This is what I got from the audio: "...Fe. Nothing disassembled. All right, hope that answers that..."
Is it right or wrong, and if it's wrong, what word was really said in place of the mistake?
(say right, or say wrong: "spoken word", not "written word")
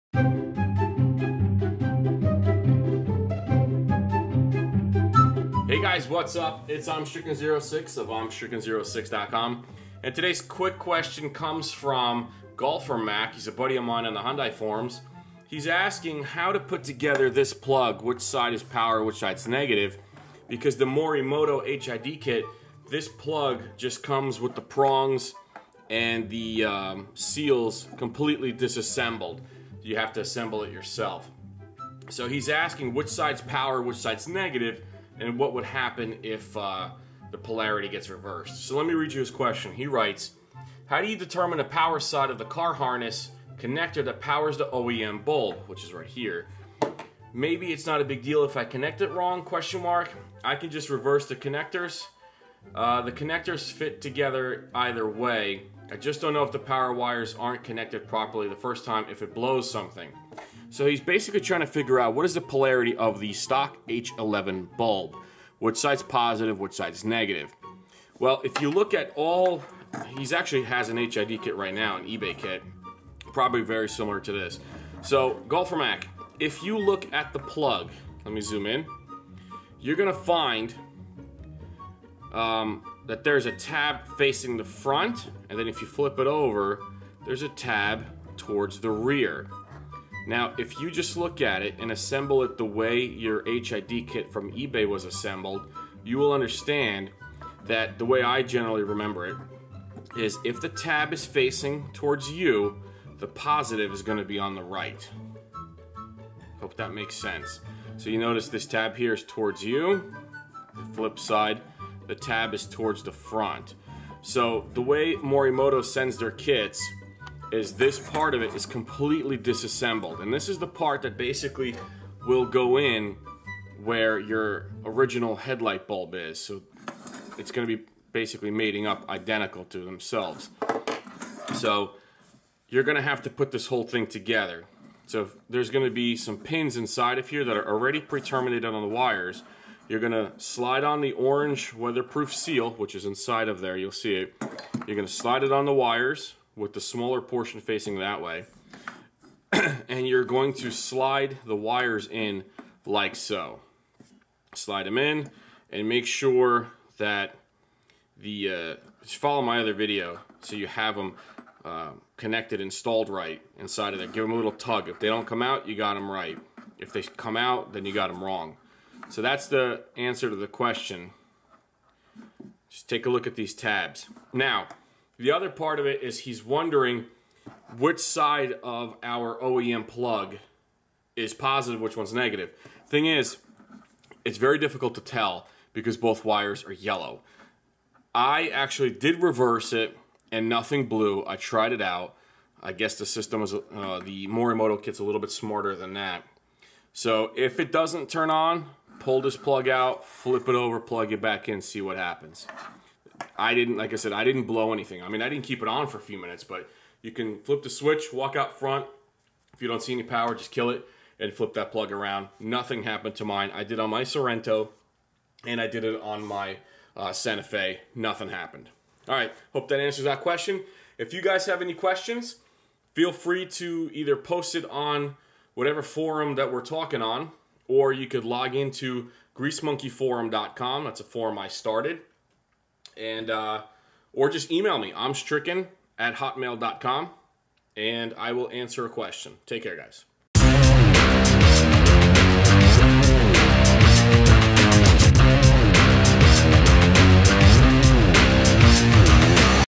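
wrong: "happened", not "disassembled".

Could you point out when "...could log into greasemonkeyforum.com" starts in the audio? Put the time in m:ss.
3:48.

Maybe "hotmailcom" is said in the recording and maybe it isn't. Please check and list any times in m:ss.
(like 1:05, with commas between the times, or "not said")
3:56.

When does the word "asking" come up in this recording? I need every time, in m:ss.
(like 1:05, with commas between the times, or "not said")
0:15, 0:32.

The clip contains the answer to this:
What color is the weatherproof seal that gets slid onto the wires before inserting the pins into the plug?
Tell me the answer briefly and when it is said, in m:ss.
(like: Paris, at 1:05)
Orange, at 2:21.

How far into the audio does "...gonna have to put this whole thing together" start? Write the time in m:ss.
2:12.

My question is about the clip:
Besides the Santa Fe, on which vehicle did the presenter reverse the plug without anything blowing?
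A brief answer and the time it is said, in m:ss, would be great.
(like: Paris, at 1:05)
Sorrento, at 3:34.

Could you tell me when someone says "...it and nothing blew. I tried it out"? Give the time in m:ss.
3:09.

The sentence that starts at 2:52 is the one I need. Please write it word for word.
Just take a look at these tabs.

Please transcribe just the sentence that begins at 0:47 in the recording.
Maybe it's not a big deal if I connect it wrong, question mark.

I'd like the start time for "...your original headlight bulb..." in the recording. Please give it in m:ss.
2:04.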